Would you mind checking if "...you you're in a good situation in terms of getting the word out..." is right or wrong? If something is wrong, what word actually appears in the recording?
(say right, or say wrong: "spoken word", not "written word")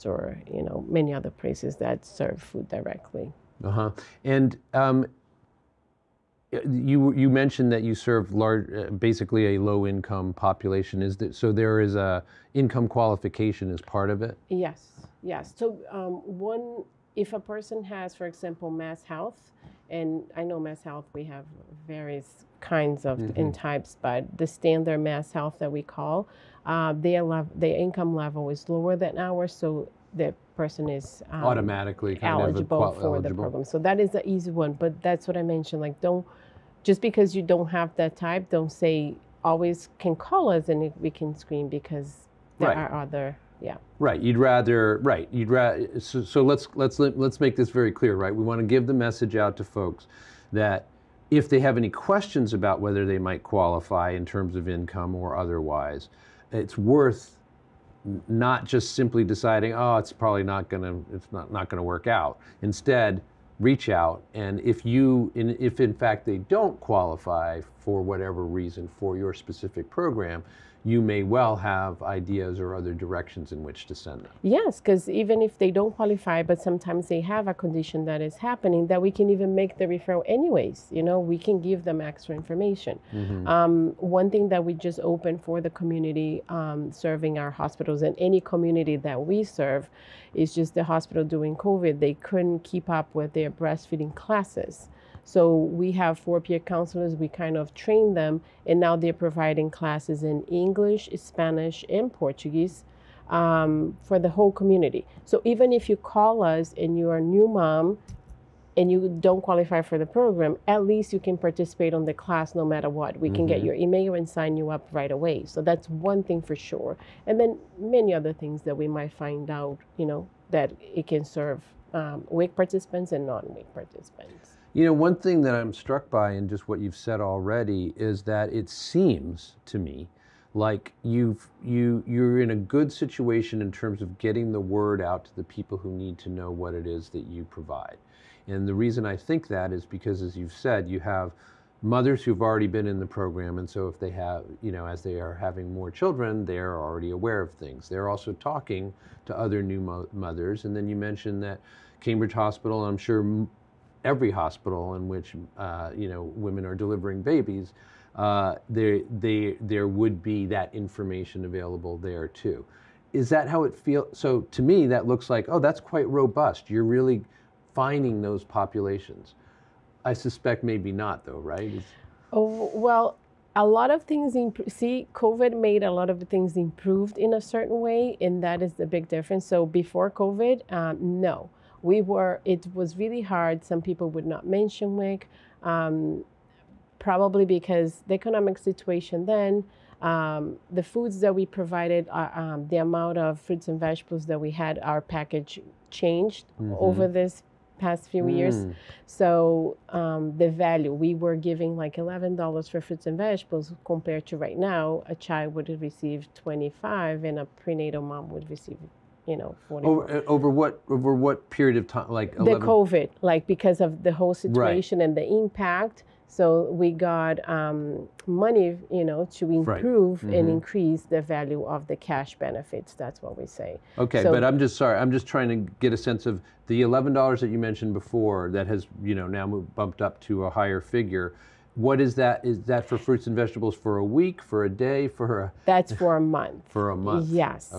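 right.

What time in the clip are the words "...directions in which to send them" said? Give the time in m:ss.
1:12.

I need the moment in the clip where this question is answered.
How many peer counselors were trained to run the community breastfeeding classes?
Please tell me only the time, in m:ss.
1:36.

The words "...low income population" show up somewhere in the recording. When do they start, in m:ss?
0:09.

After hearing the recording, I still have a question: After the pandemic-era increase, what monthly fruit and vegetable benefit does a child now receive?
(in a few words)
$25.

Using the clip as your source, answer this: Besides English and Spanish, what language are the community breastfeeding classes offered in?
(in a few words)
Portuguese.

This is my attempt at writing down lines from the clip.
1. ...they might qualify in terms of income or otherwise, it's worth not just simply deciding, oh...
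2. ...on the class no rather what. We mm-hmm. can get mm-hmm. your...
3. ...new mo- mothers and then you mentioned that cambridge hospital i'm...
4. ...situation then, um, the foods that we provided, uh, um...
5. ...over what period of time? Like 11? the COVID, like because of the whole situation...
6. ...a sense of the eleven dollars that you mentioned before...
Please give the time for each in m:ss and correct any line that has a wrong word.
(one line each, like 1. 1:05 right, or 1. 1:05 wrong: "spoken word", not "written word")
1. 0:53 right
2. 1:51 wrong: "matter", not "rather"
3. 2:29 right
4. 3:08 right
5. 3:30 right
6. 3:45 right.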